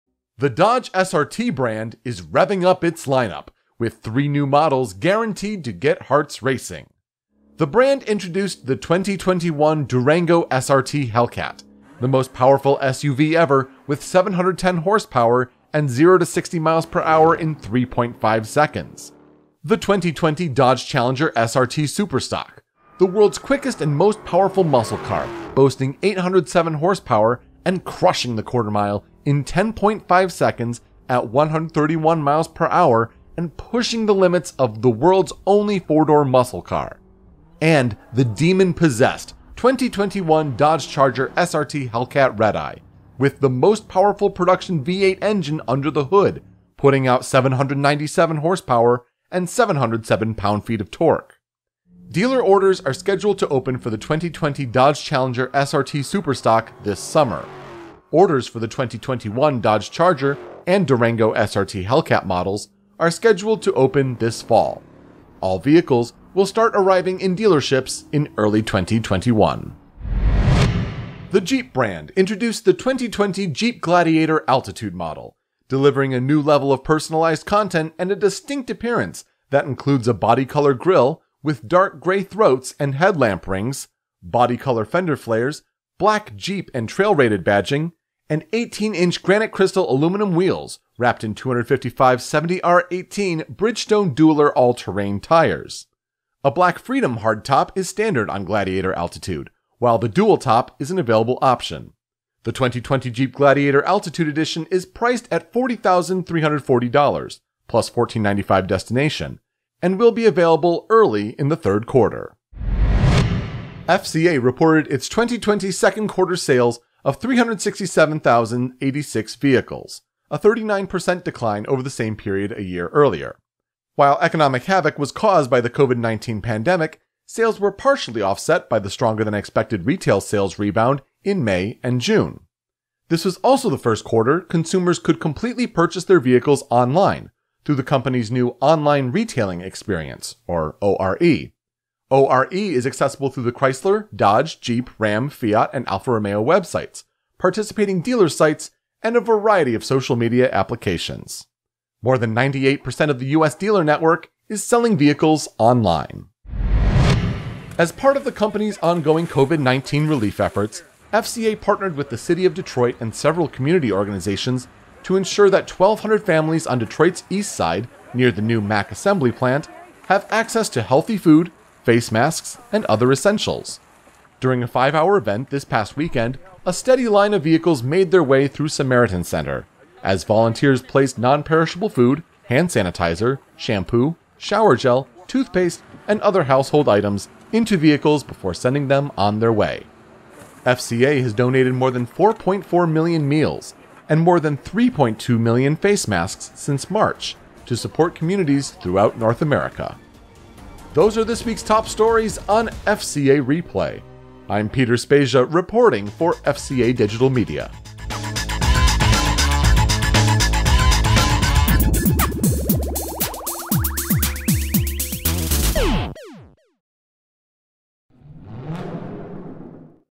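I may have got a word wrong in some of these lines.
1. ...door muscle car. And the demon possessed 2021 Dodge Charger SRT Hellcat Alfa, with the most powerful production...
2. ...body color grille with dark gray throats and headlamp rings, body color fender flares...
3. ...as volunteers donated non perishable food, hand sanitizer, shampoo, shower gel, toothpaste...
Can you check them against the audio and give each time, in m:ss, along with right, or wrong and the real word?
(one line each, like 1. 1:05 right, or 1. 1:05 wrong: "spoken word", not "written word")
1. 0:36 wrong: "Redeye", not "Alfa"
2. 1:20 right
3. 3:00 wrong: "placed", not "donated".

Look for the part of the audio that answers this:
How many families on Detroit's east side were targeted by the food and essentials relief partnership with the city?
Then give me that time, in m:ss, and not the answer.
2:45.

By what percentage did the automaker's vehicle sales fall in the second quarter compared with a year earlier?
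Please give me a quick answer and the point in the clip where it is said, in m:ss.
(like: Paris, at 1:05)
39%, at 2:00.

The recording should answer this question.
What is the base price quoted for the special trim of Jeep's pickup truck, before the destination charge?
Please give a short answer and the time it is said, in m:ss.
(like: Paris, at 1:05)
$40,340, at 1:45.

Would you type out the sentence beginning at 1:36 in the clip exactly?
A black Freedom hardtop is standard on Gladiator Altitude, while the dual top is an available option.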